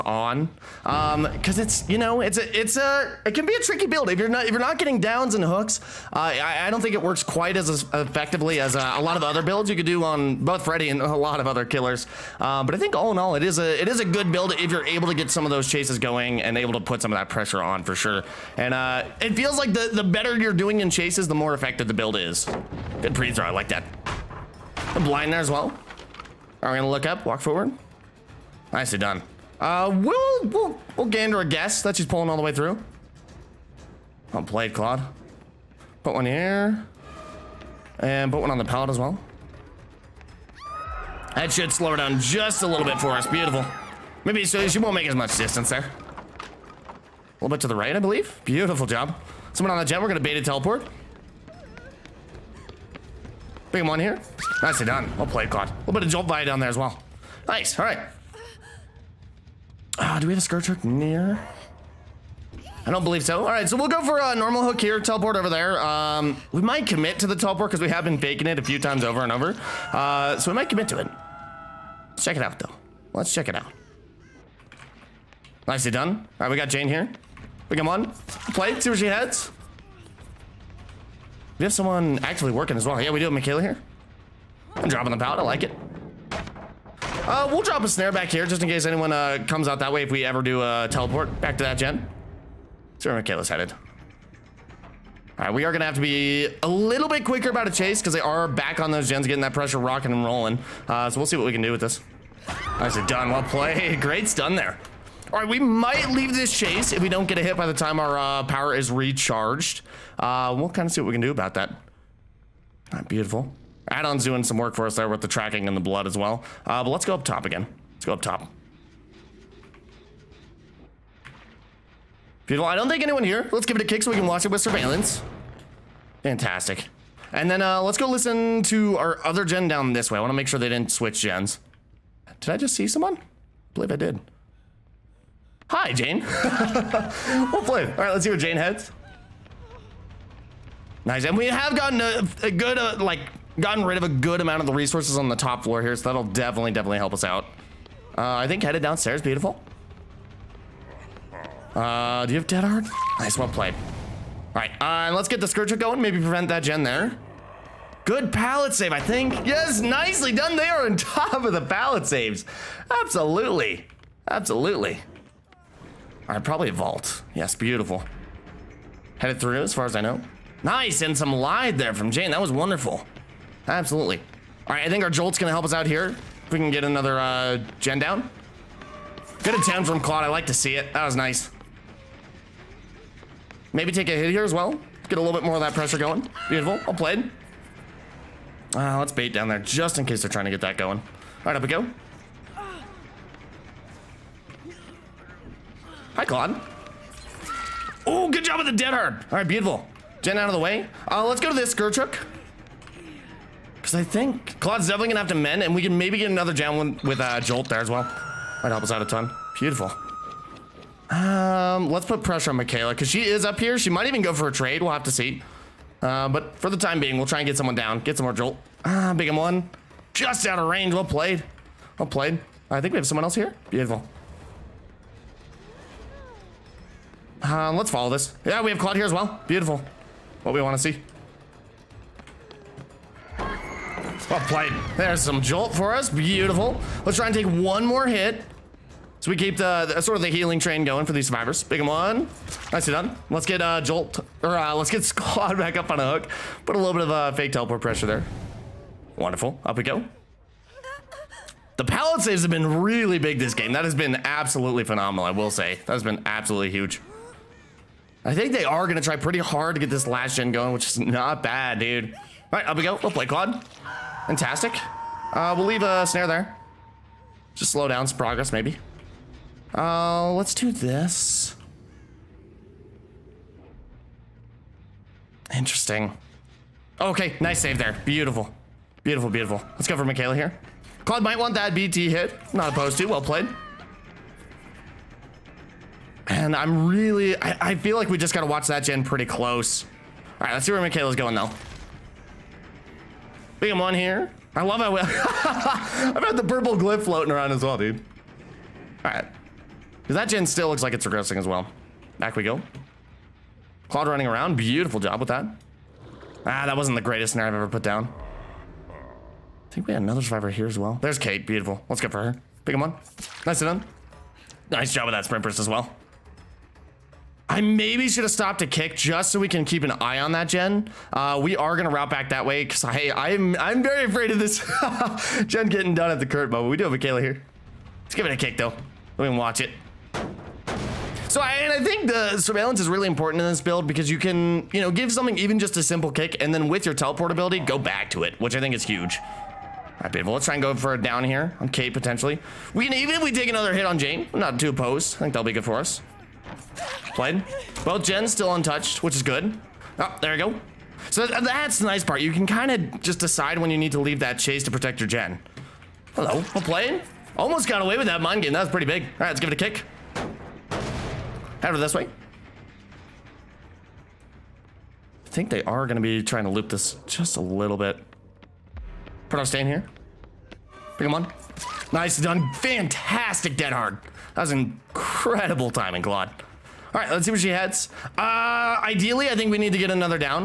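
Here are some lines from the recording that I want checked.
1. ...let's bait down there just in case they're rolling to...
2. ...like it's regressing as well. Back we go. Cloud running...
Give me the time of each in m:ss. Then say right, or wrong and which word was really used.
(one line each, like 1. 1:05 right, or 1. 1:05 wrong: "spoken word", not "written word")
1. 3:08 wrong: "trying", not "rolling"
2. 5:00 right.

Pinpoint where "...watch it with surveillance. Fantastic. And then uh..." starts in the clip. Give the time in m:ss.
2:04.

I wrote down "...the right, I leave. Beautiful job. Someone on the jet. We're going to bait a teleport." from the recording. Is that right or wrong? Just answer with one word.
wrong.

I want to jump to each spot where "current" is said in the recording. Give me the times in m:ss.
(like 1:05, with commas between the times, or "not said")
5:26.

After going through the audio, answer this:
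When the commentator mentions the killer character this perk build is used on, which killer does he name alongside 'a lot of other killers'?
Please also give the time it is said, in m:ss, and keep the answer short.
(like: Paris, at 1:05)
Freddy, at 0:10.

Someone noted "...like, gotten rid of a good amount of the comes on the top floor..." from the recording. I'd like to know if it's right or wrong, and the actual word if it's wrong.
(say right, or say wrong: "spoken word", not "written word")
wrong: "resources", not "comes".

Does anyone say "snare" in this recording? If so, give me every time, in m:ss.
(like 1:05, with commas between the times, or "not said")
1:27, 4:26, 5:07.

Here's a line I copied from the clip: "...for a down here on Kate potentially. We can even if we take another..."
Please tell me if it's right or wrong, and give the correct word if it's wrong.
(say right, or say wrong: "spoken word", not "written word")
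right.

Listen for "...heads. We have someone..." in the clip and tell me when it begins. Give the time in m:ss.
1:19.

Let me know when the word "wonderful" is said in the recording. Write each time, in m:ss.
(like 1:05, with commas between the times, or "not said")
2:52, 4:09.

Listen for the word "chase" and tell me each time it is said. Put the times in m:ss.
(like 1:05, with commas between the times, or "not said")
0:15, 0:20, 1:37, 1:46, 5:54.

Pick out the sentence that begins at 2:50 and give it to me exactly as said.
Nice, and some lied there from Jane.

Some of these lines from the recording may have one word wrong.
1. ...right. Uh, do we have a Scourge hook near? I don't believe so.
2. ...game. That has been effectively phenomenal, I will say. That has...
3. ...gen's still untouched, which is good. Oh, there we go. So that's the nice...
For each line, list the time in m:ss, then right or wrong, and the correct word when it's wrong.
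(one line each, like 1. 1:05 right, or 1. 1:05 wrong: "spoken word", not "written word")
1. 0:57 right
2. 4:13 wrong: "absolutely", not "effectively"
3. 5:47 right.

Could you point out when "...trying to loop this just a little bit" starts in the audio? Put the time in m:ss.
6:06.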